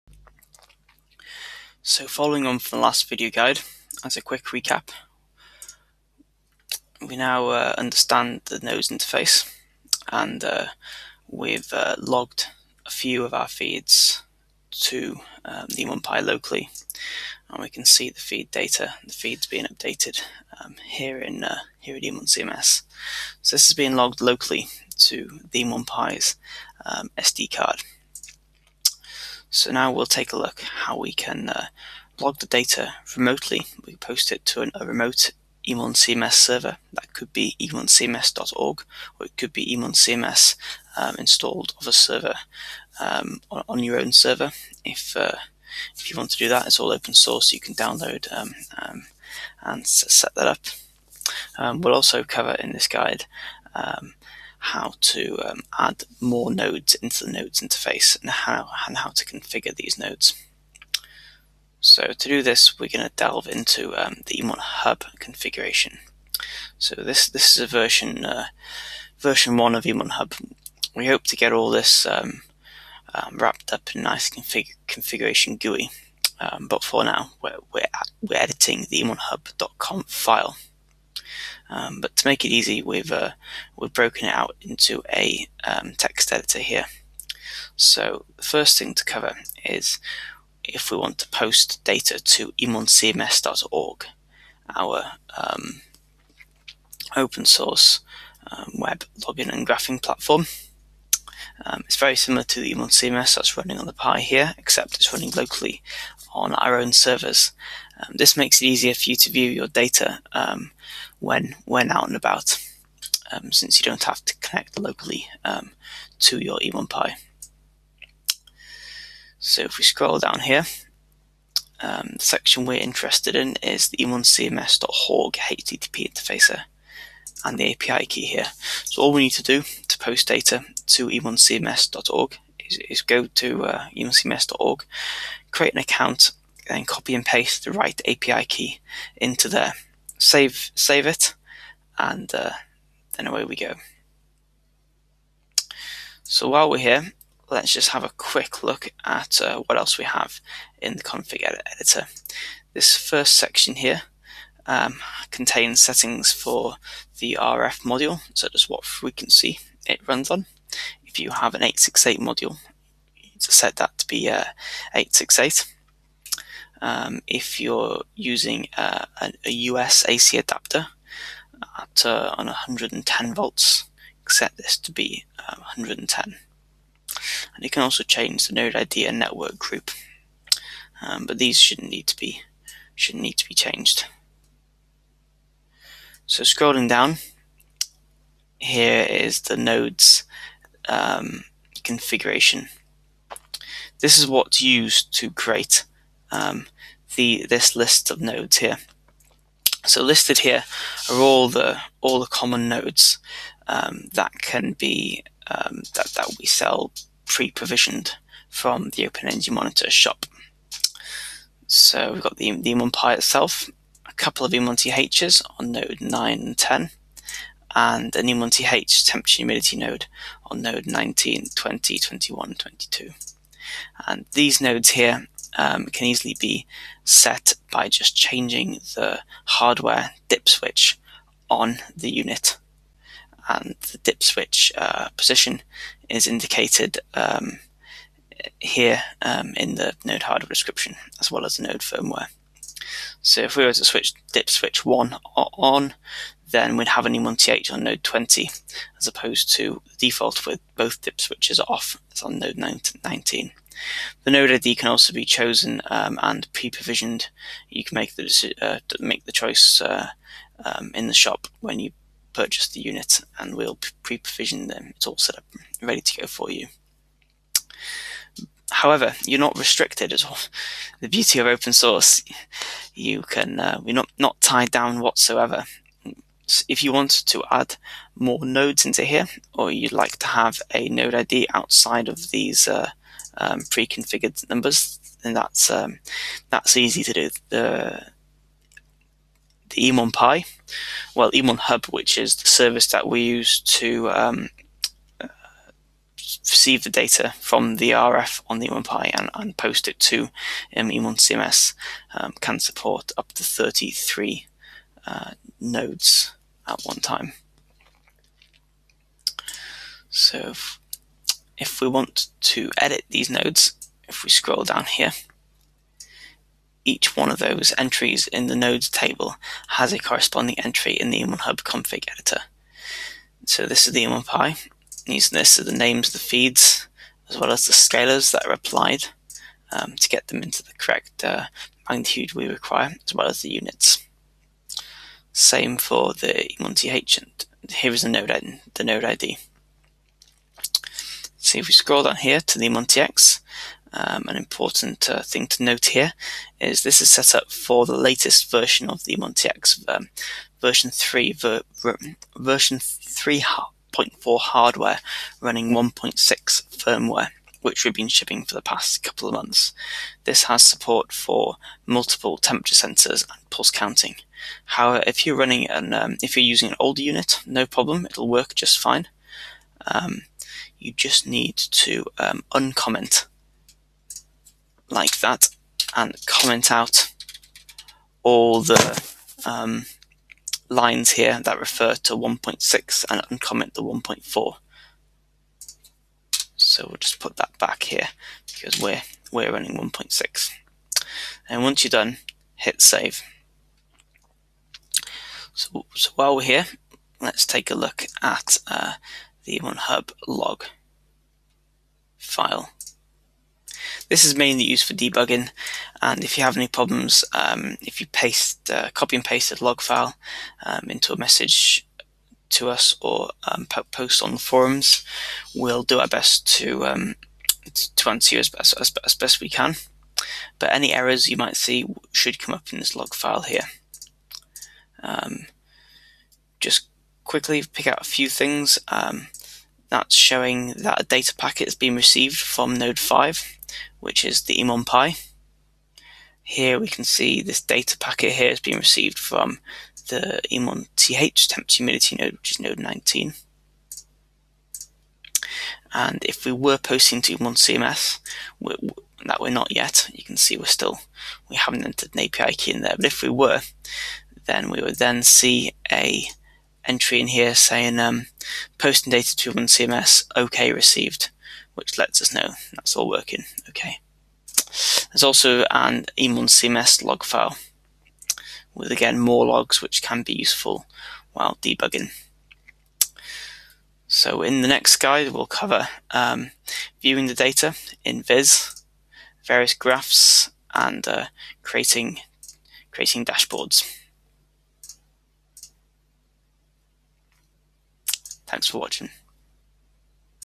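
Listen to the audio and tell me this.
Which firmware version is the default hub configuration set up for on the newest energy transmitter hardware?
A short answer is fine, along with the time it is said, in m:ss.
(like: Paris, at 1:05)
1.6, at 5:55.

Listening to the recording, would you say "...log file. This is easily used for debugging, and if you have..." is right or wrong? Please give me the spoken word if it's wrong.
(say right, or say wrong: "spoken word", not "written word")
wrong: "mainly", not "easily".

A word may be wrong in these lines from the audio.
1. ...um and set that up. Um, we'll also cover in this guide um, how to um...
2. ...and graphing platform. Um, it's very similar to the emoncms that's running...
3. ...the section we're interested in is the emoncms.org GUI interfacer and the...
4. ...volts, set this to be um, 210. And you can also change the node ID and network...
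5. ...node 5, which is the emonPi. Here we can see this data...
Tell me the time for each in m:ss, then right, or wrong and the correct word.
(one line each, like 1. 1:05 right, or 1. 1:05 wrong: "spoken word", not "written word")
1. 0:48 right
2. 1:39 right
3. 2:02 wrong: "HTTP", not "GUI"
4. 2:53 wrong: "110", not "210"
5. 7:12 right.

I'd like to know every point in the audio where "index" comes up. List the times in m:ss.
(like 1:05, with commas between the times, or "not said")
not said.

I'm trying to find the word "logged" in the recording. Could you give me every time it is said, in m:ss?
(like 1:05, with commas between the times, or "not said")
0:11, 0:23.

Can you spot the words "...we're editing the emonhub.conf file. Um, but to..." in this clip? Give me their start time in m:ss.
1:18.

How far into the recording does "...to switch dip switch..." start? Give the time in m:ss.
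4:03.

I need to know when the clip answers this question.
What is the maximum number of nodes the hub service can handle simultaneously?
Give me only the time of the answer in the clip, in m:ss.
5:03.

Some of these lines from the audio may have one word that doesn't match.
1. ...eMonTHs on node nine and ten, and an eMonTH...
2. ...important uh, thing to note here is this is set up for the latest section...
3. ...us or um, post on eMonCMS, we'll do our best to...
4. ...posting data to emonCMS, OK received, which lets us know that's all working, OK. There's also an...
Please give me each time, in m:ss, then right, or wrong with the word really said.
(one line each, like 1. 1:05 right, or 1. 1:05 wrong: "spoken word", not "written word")
1. 3:34 right
2. 5:44 wrong: "version", not "section"
3. 6:52 wrong: "forums", not "eMonCMS"
4. 7:38 right.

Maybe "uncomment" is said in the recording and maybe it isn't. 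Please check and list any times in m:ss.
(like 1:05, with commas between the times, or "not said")
6:12, 6:23.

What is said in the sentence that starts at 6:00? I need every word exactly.
This has support for multiple temperature sensors and pulse counting.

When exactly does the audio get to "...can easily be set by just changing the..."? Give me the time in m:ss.
3:45.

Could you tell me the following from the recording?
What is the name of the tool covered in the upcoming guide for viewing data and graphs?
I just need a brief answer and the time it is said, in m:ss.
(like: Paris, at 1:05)
Viz, at 7:58.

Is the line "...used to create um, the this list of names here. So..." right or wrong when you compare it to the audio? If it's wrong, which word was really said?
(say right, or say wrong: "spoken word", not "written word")
wrong: "nodes", not "names".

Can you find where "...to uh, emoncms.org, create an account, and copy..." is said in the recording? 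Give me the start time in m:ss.
2:13.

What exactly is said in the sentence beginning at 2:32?
This first section here um, contains settings for the RF module, so just what frequency it runs on.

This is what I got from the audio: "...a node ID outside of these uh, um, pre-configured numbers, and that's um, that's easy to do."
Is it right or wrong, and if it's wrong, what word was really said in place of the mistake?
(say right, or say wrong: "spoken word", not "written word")
right.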